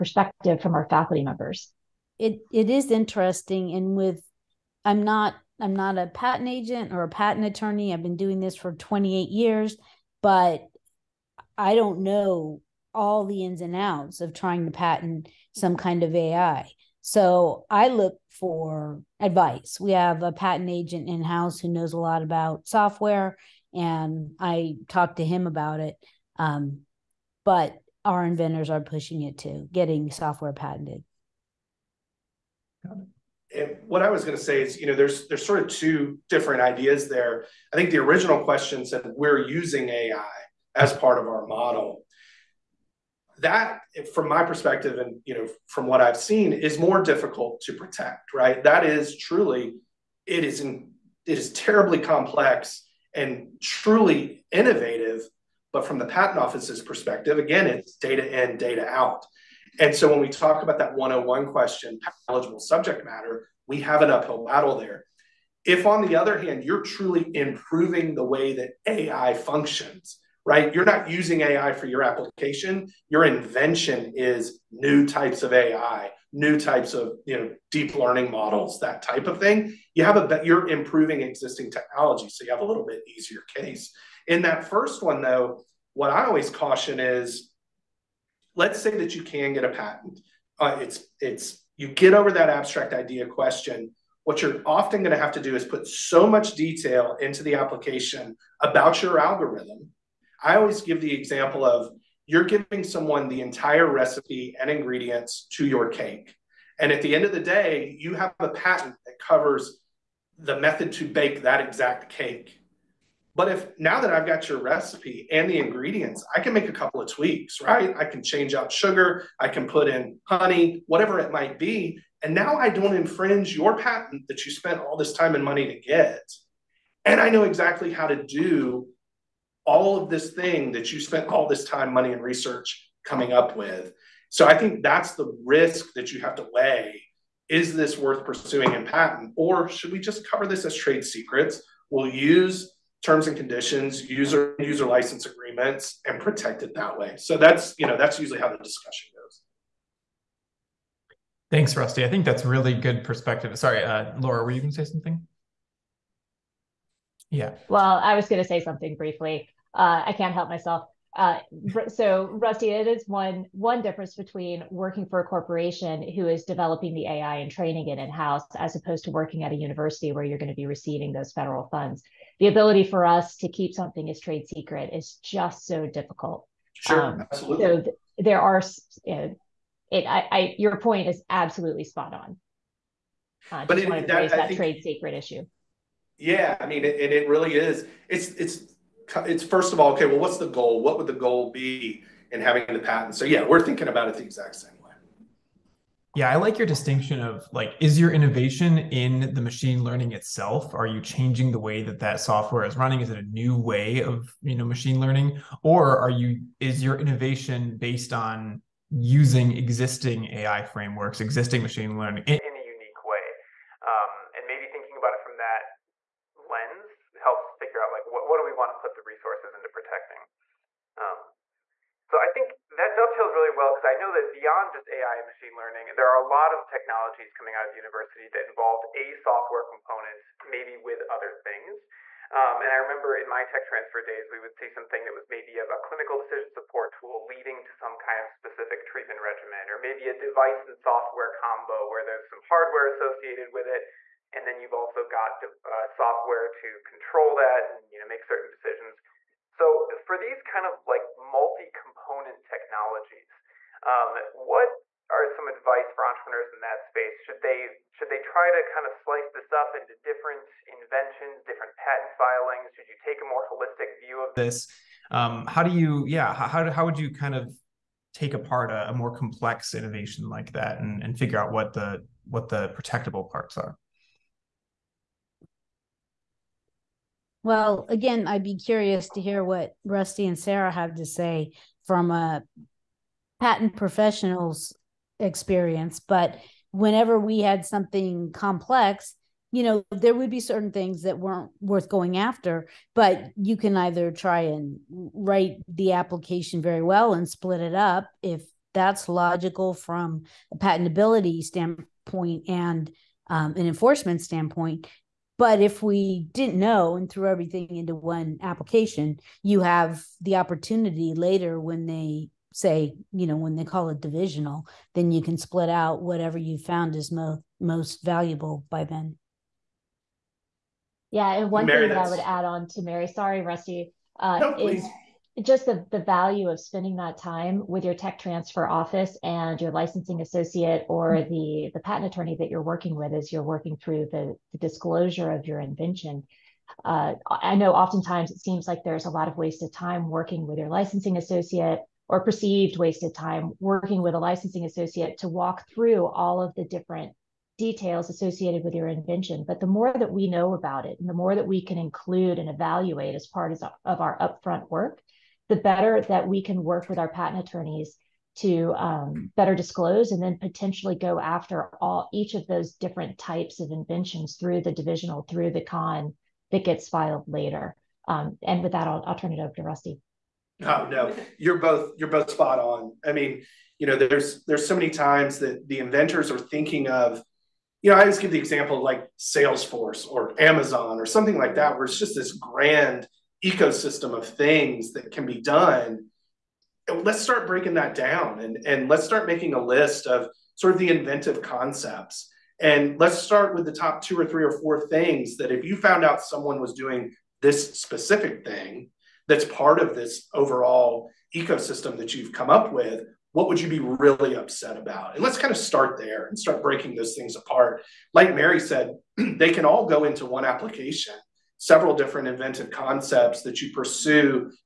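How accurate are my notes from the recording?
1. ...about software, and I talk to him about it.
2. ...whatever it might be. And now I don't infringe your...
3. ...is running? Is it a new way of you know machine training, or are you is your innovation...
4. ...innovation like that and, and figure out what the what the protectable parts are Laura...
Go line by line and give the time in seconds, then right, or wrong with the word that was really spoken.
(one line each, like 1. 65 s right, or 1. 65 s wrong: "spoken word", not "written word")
1. 22 s right
2. 120 s right
3. 202 s wrong: "learning", not "training"
4. 269 s wrong: "Well", not "Laura".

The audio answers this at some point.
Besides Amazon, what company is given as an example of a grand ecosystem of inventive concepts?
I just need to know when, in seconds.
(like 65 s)
379 s.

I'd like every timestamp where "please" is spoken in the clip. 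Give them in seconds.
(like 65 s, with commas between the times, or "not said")
not said.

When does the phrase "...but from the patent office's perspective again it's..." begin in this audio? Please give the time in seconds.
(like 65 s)
55 s.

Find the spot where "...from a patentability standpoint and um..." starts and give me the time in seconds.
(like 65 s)
299 s.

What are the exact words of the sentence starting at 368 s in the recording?
Um, and with that, I'll, I'll turn it over to Rusty.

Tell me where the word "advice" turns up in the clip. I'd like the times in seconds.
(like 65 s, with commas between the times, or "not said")
19 s, 255 s.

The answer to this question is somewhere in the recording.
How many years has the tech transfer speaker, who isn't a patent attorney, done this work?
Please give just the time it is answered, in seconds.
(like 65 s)
8 s.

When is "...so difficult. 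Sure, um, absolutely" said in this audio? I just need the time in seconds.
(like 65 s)
175 s.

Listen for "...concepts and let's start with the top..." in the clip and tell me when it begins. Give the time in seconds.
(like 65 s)
391 s.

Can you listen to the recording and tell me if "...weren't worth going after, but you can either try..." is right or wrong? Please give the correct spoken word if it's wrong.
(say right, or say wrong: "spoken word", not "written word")
right.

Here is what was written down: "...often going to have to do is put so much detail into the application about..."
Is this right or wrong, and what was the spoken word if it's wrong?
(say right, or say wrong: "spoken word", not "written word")
right.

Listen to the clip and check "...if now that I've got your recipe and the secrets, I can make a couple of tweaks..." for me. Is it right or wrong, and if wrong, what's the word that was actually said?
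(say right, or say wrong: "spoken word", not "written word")
wrong: "ingredients", not "secrets".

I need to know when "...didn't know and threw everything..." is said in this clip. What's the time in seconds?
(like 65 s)
306 s.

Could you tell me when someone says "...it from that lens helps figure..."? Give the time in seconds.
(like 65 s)
215 s.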